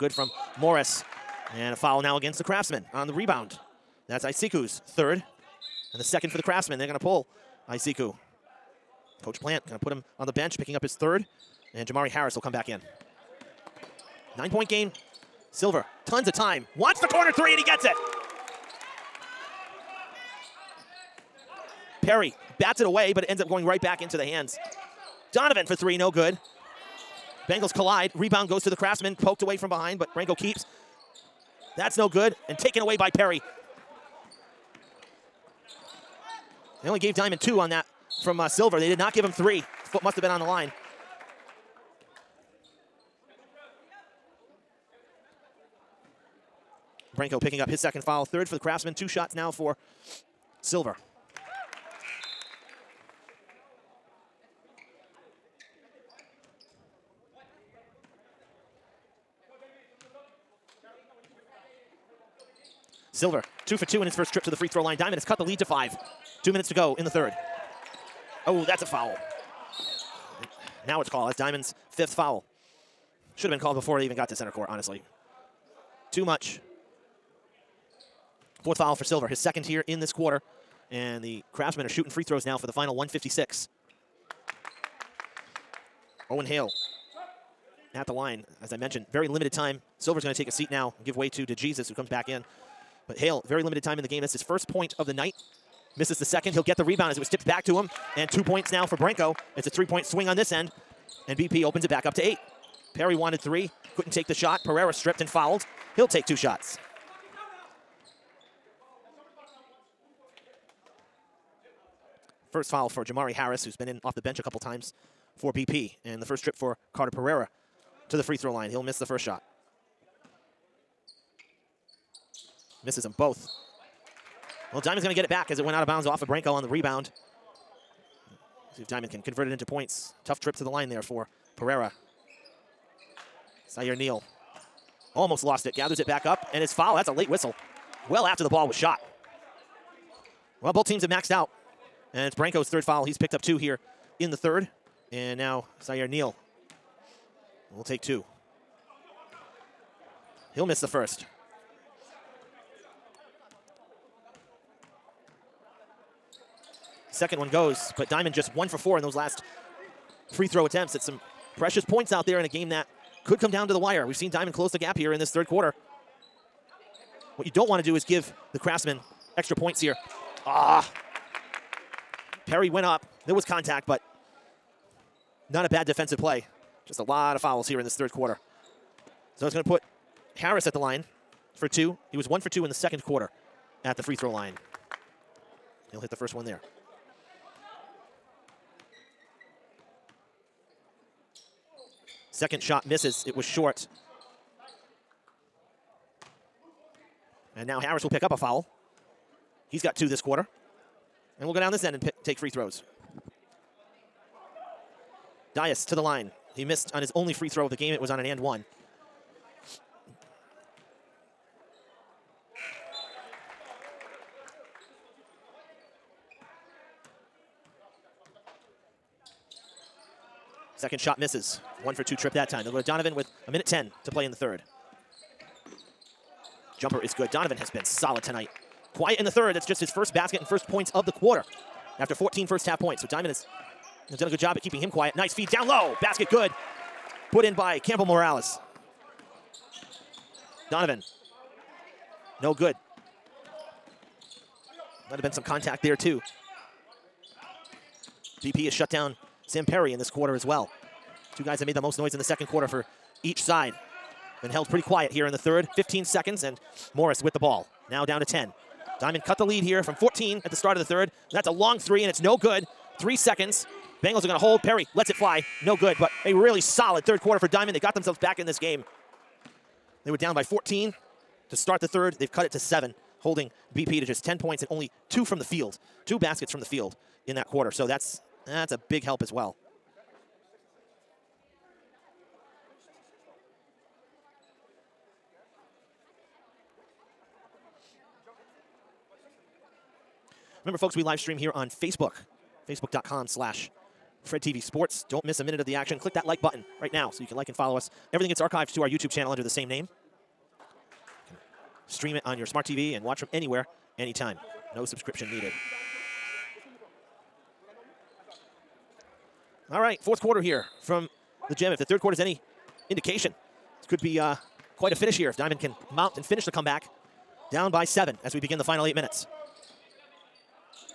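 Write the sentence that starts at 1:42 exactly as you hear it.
Perry wanted three, couldn't take the shot.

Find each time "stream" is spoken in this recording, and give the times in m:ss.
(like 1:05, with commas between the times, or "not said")
4:51, 5:01.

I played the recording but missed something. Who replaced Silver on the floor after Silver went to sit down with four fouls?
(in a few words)
DeJesus.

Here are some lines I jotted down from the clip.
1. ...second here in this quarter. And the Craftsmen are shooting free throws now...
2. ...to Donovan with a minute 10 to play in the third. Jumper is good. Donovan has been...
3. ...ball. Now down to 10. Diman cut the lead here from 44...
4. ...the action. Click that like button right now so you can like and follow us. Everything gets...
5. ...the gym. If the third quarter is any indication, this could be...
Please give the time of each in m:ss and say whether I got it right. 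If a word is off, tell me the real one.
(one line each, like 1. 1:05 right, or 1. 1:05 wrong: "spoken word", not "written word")
1. 1:19 right
2. 3:42 right
3. 4:17 wrong: "14", not "44"
4. 4:55 right
5. 5:11 right.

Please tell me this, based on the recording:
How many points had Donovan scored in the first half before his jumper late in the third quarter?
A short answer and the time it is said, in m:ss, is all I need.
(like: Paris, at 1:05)
14, at 3:52.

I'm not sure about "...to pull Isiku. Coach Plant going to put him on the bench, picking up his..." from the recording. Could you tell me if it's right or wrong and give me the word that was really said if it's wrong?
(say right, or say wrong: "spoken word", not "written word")
right.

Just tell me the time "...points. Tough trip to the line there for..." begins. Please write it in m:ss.
2:09.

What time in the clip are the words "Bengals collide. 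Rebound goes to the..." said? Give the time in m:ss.
0:27.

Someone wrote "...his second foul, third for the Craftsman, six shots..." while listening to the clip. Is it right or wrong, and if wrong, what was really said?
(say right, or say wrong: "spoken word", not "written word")
wrong: "two", not "six".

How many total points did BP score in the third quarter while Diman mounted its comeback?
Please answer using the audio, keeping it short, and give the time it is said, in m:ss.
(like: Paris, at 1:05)
10, at 4:34.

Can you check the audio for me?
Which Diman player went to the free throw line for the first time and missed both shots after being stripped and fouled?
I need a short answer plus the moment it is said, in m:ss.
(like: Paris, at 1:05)
Carter Pereira, at 1:56.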